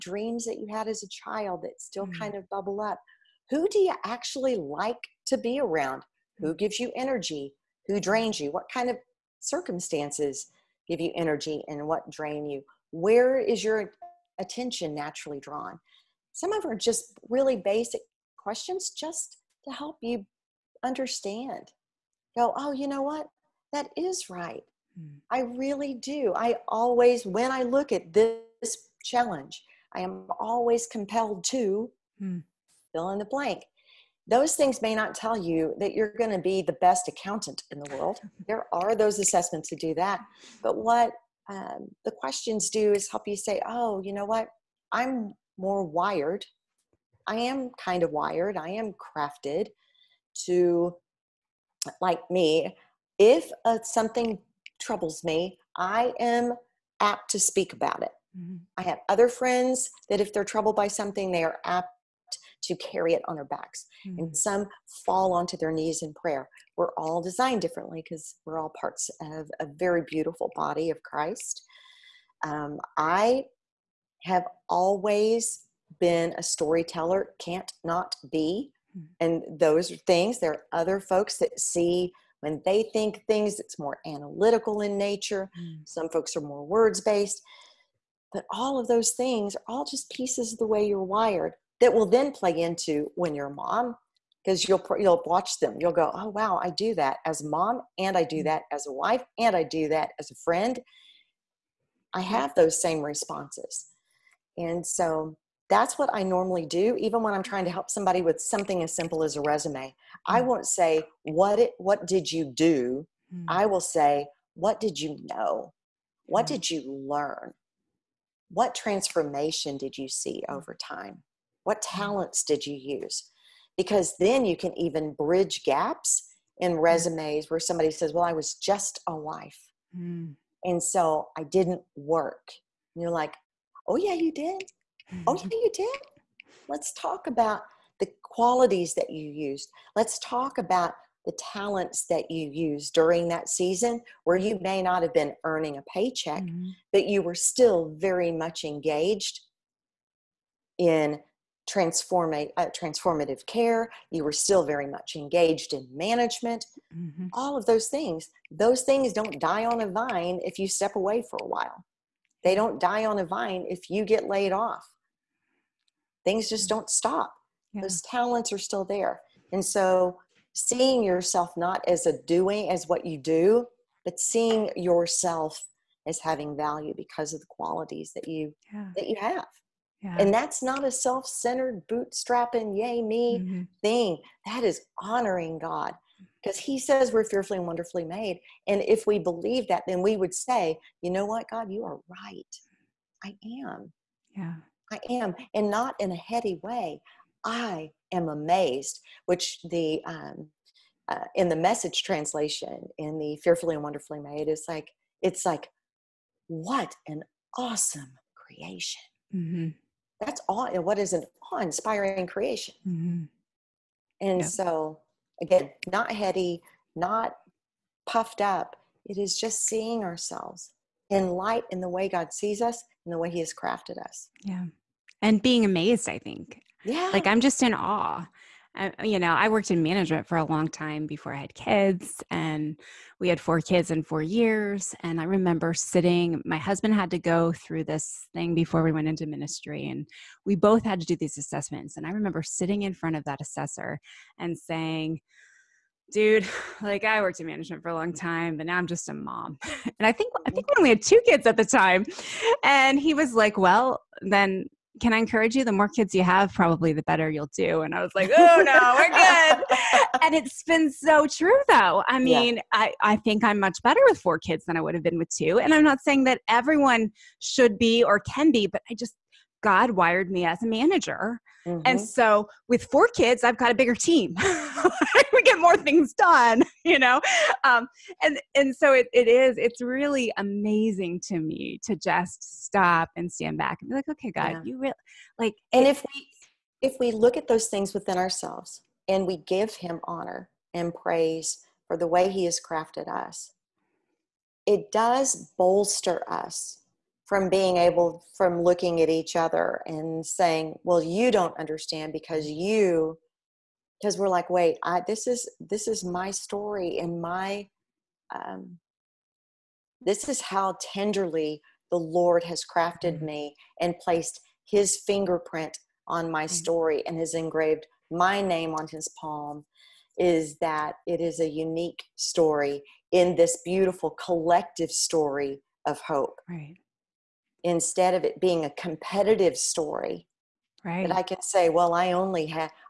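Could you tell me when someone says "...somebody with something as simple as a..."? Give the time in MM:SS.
01:47.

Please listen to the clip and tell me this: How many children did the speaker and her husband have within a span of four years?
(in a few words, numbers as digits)
4.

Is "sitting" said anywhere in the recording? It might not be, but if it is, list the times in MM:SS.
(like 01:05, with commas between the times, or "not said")
03:55, 04:02.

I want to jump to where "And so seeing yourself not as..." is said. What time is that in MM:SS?
02:49.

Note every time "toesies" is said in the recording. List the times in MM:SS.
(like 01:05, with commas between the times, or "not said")
not said.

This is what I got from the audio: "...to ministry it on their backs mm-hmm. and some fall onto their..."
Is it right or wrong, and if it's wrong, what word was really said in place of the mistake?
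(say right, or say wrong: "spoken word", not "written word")
wrong: "carry", not "ministry".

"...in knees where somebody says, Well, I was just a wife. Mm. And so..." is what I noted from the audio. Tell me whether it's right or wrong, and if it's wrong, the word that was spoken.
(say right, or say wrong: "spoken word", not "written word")
wrong: "resumes", not "knees".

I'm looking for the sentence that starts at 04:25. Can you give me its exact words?
And I'm not saying that everyone should be or can be, but I just God wired me as a manager.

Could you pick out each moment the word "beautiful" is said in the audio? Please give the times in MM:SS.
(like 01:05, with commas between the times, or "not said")
01:10, 05:23.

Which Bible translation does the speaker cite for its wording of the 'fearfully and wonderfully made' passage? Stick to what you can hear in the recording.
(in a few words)
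The Message.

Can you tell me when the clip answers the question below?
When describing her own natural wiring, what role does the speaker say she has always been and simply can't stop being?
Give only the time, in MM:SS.
01:16.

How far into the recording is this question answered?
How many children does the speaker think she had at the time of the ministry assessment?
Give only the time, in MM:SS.
04:11.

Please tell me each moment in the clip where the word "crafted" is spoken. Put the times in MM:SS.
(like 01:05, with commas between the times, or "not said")
00:48, 03:43, 04:52, 05:12.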